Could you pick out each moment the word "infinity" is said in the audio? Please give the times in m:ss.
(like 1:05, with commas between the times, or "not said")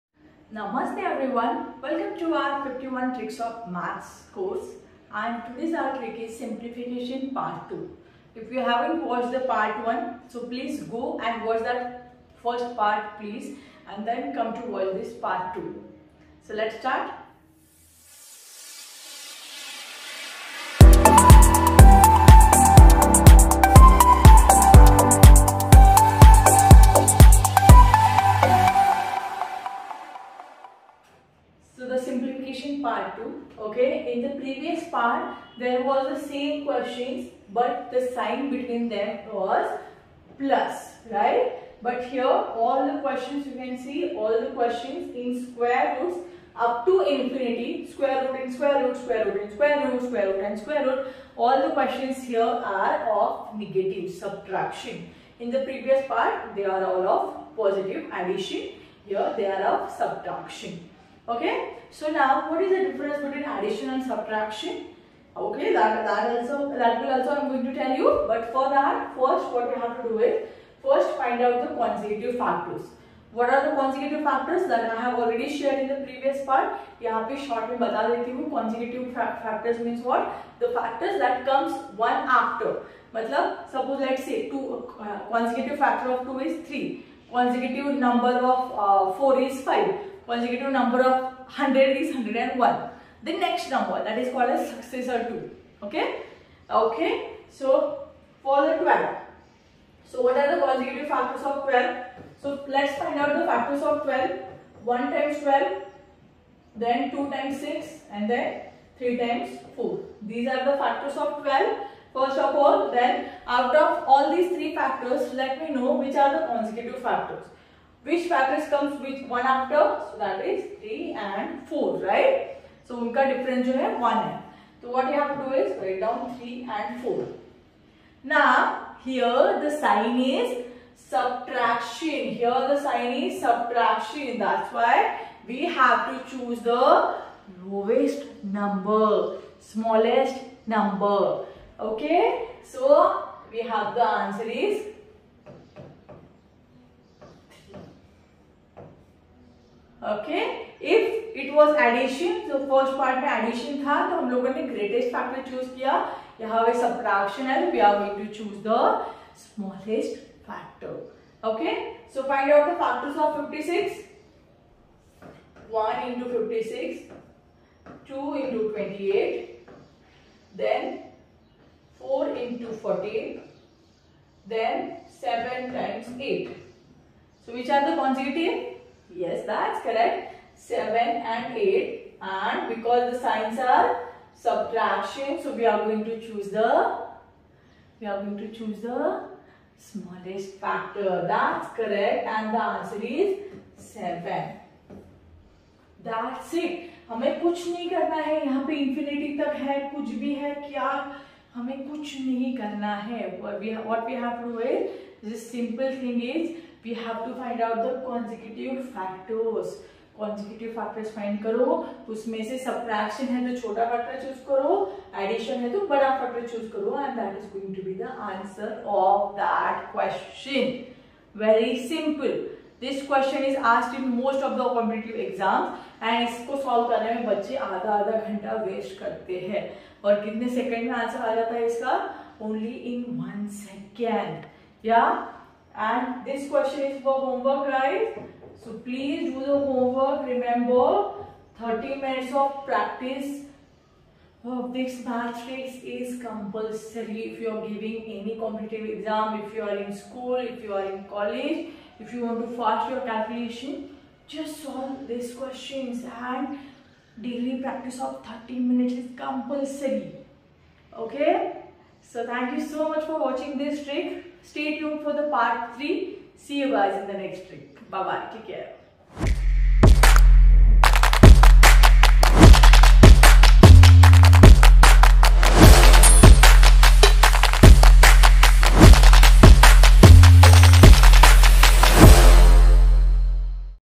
0:47.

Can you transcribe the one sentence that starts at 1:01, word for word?
So now what is the difference between addition and subtraction?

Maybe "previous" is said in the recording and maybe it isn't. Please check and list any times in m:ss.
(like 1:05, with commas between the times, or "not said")
0:55, 1:16.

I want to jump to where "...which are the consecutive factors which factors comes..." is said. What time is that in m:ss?
1:56.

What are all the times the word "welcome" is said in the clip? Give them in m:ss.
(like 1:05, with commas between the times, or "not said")
0:01.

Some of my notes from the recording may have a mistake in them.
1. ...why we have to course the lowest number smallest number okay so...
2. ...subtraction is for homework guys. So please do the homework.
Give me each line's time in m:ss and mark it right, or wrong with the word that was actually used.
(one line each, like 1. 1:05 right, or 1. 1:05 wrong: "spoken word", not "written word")
1. 2:14 wrong: "choose", not "course"
2. 3:56 wrong: "question", not "subtraction".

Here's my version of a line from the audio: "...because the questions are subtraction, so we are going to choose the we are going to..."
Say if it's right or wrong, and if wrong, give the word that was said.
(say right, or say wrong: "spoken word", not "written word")
wrong: "signs", not "questions".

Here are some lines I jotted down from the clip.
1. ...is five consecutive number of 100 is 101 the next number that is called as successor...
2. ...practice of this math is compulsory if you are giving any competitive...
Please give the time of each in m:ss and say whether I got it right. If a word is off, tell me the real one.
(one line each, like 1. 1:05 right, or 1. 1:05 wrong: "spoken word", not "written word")
1. 1:29 right
2. 4:02 right.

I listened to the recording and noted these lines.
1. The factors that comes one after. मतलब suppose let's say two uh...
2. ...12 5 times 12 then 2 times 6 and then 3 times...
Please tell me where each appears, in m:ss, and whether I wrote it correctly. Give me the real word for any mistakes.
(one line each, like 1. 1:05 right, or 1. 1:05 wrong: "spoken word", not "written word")
1. 1:20 right
2. 1:44 wrong: "1", not "5".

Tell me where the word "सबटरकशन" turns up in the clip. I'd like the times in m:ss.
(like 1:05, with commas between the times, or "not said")
2:36, 3:32.